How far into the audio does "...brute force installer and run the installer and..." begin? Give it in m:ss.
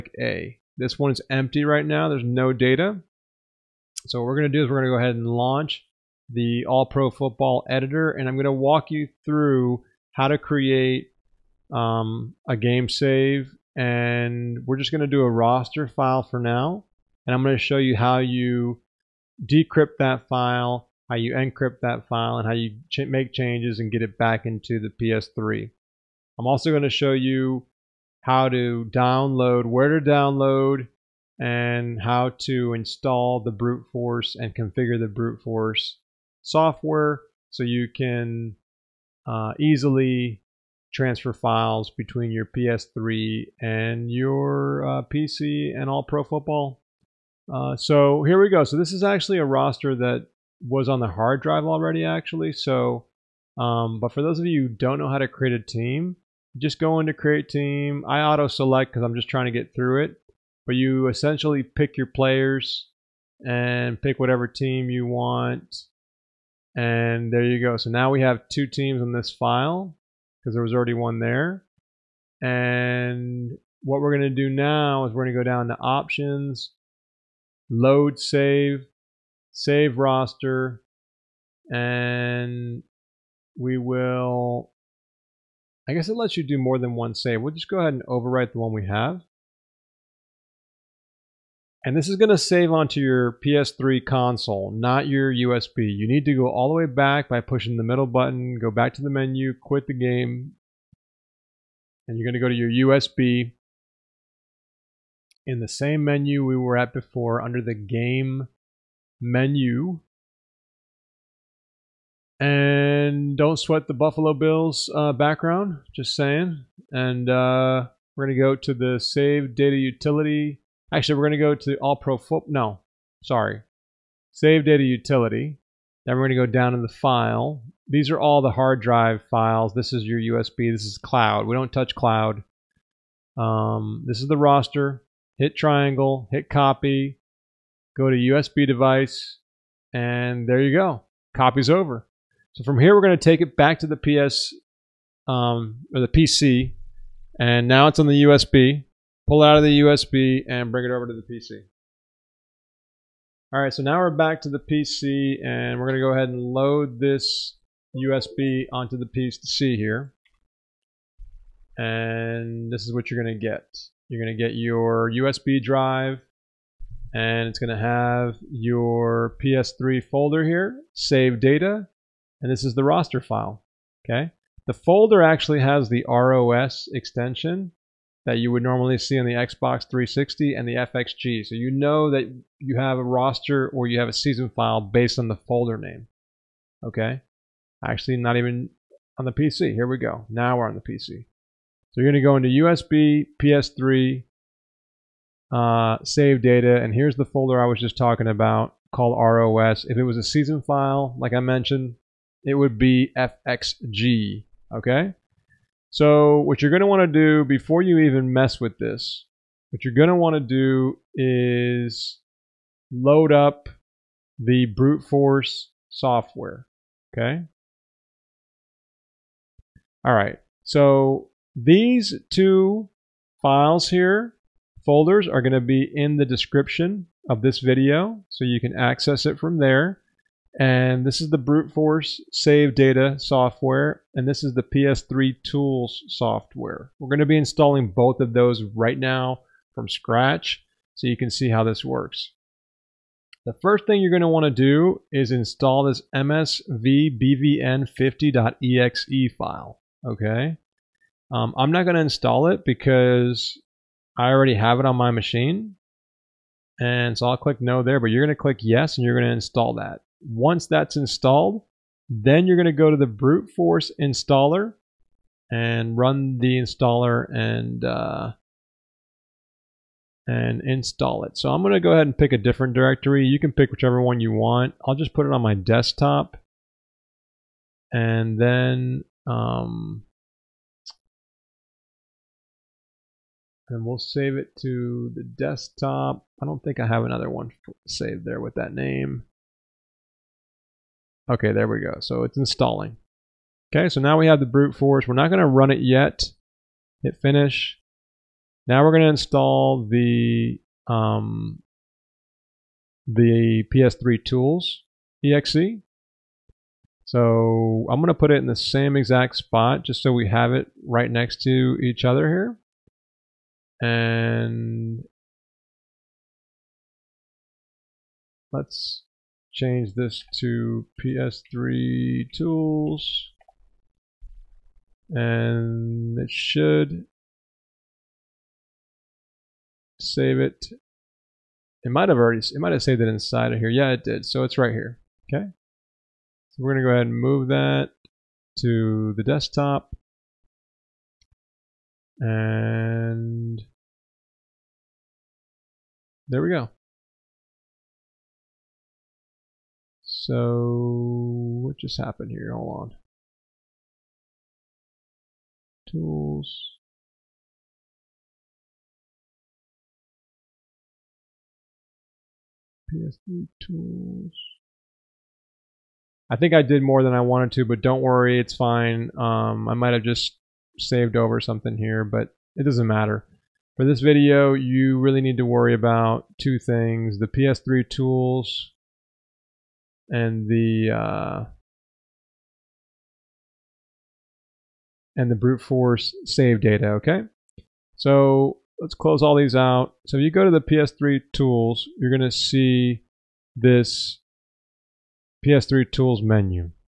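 4:23.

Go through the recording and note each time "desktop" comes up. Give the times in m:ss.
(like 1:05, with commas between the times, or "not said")
4:35, 4:45, 5:39.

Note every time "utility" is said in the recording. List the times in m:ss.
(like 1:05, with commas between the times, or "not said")
1:59, 2:04.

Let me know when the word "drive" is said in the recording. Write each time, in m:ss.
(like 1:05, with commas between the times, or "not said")
0:51, 2:08, 2:45.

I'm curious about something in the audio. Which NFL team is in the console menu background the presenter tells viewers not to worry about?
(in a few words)
Buffalo Bills.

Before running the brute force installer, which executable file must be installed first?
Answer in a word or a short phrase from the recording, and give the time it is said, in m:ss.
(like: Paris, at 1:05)
msvbvm50.exe, at 4:06.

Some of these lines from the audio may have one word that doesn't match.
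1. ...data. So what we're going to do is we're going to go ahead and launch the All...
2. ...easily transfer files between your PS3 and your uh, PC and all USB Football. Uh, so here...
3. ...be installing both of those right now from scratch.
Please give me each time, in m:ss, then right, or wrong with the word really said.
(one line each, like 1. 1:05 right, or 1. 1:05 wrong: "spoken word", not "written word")
1. 0:02 right
2. 0:39 wrong: "Pro", not "USB"
3. 3:57 right.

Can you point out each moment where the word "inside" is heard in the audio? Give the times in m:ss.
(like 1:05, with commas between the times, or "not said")
5:33.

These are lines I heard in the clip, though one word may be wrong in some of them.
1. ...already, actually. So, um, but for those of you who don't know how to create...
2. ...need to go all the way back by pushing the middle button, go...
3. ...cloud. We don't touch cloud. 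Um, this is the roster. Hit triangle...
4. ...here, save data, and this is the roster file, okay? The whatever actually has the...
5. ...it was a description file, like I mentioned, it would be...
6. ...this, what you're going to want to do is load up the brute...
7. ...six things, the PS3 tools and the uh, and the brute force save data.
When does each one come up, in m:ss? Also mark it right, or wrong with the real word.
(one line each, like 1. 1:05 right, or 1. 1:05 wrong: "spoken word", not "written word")
1. 0:51 right
2. 1:36 right
3. 2:10 right
4. 2:50 wrong: "folder", not "whatever"
5. 3:19 wrong: "season", not "description"
6. 3:28 right
7. 6:16 wrong: "two", not "six".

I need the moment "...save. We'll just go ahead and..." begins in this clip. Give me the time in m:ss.
1:27.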